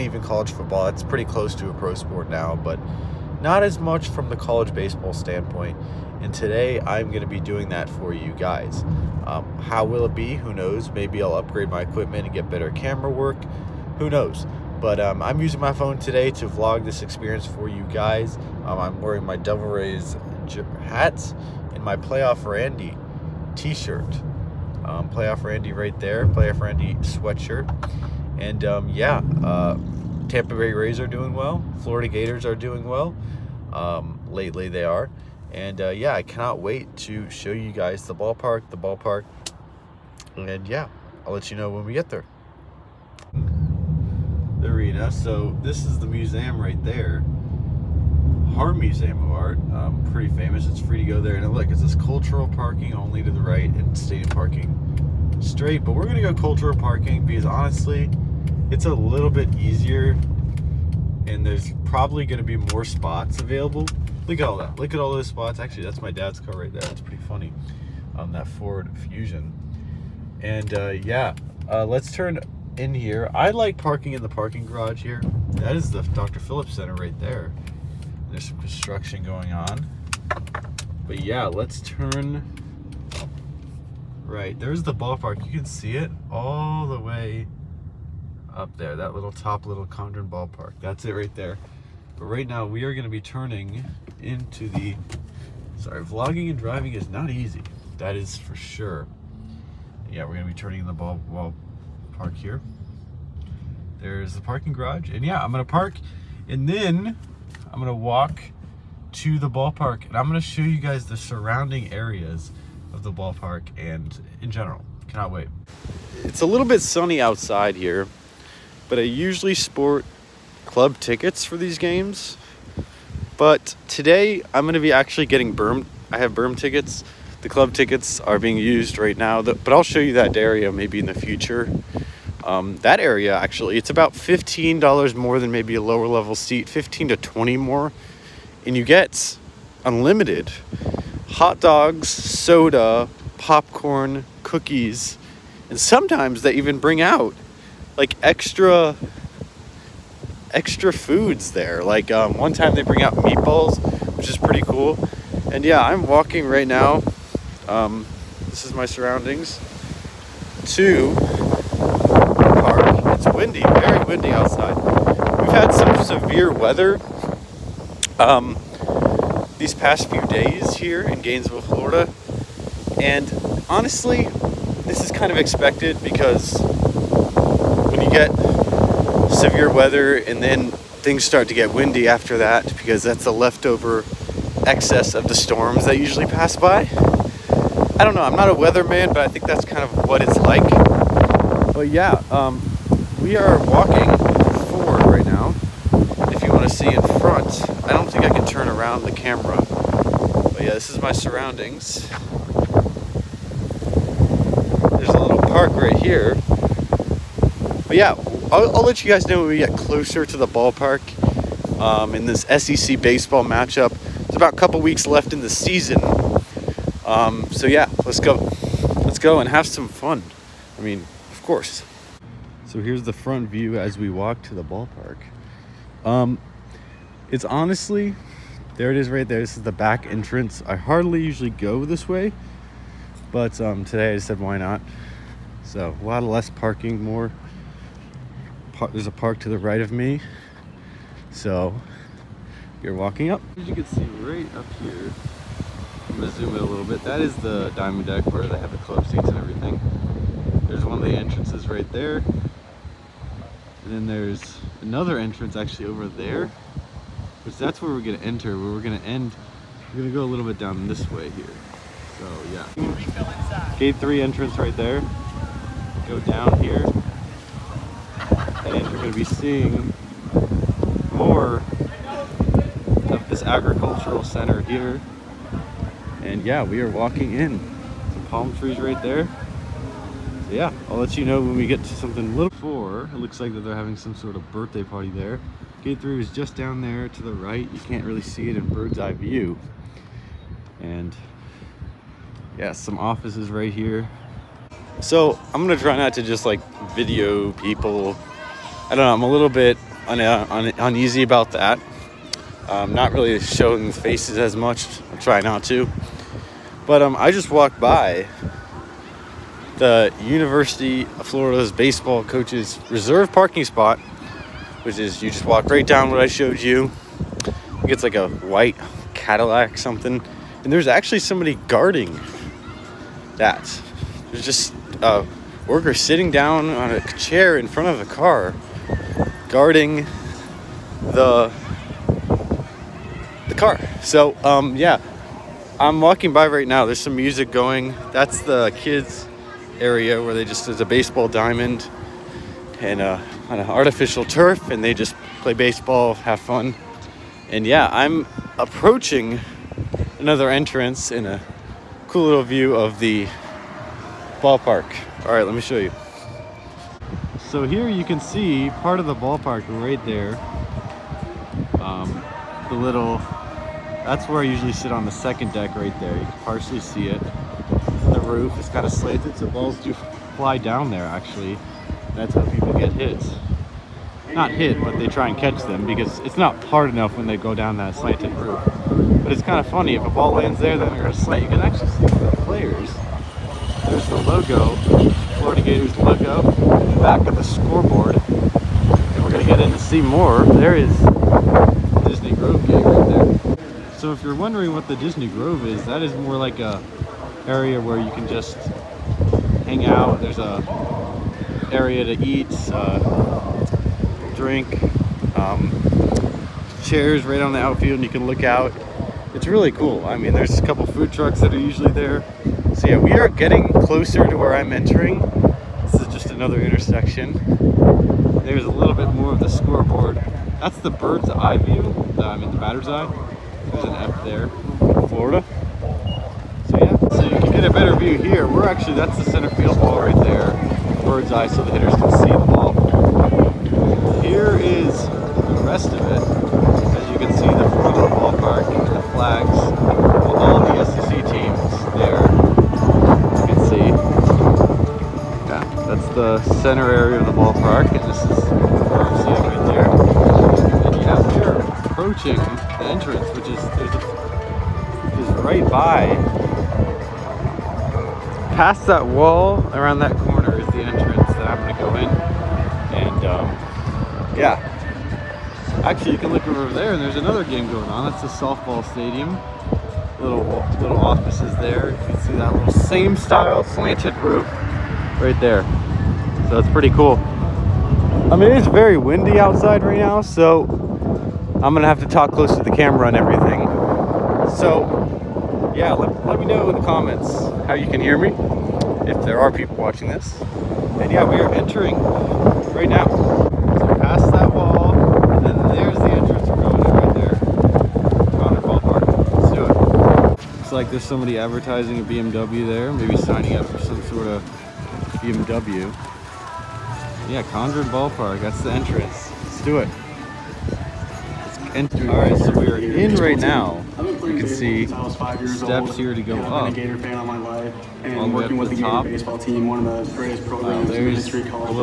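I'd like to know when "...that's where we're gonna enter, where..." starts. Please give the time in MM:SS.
04:17.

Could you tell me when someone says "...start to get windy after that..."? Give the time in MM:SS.
03:01.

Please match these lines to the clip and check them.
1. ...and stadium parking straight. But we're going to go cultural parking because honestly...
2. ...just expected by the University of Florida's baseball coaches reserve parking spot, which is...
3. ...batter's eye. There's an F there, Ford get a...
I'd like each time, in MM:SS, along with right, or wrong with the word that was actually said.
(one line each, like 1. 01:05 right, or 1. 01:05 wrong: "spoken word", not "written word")
1. 00:53 right
2. 05:07 wrong: "walked", not "expected"
3. 07:02 wrong: "Florida", not "Ford".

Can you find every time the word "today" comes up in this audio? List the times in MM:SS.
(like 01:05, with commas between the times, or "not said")
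00:06, 00:15, 02:03, 03:53.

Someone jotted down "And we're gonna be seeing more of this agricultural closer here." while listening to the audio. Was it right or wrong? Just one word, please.
wrong.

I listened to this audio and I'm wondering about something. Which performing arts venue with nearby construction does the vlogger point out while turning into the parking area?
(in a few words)
Dr. Phillips Center.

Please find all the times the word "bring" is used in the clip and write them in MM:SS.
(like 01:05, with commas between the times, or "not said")
02:26, 02:32.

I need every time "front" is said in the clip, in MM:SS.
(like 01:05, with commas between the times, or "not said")
03:17, 03:43, 05:27, 07:17.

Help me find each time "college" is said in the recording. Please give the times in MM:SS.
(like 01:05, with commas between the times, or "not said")
00:00, 00:04.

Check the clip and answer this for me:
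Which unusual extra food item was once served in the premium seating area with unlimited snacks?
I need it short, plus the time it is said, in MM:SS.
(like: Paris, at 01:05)
Meatballs, at 02:33.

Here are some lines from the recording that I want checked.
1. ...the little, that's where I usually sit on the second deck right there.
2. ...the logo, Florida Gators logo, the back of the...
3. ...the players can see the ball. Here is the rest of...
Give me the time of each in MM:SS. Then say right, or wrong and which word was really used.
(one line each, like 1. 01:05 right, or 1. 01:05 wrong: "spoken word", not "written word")
1. 06:02 right
2. 06:24 right
3. 07:11 wrong: "hitters", not "players".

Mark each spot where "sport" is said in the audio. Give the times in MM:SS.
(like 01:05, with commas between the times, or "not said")
00:01, 01:59.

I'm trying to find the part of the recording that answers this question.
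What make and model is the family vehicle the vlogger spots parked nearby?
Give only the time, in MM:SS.
01:08.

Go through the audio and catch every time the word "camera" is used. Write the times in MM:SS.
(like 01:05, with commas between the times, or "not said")
00:12, 03:19, 08:02.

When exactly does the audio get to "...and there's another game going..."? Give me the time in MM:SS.
07:46.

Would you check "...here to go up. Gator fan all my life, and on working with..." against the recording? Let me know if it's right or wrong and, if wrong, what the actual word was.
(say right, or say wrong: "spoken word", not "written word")
right.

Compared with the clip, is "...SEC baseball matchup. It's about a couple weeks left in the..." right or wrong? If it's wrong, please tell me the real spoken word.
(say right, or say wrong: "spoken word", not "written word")
right.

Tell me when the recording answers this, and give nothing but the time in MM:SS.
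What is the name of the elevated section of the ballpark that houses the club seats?
04:07.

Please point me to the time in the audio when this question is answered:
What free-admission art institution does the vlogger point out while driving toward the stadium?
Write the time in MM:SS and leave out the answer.
00:48.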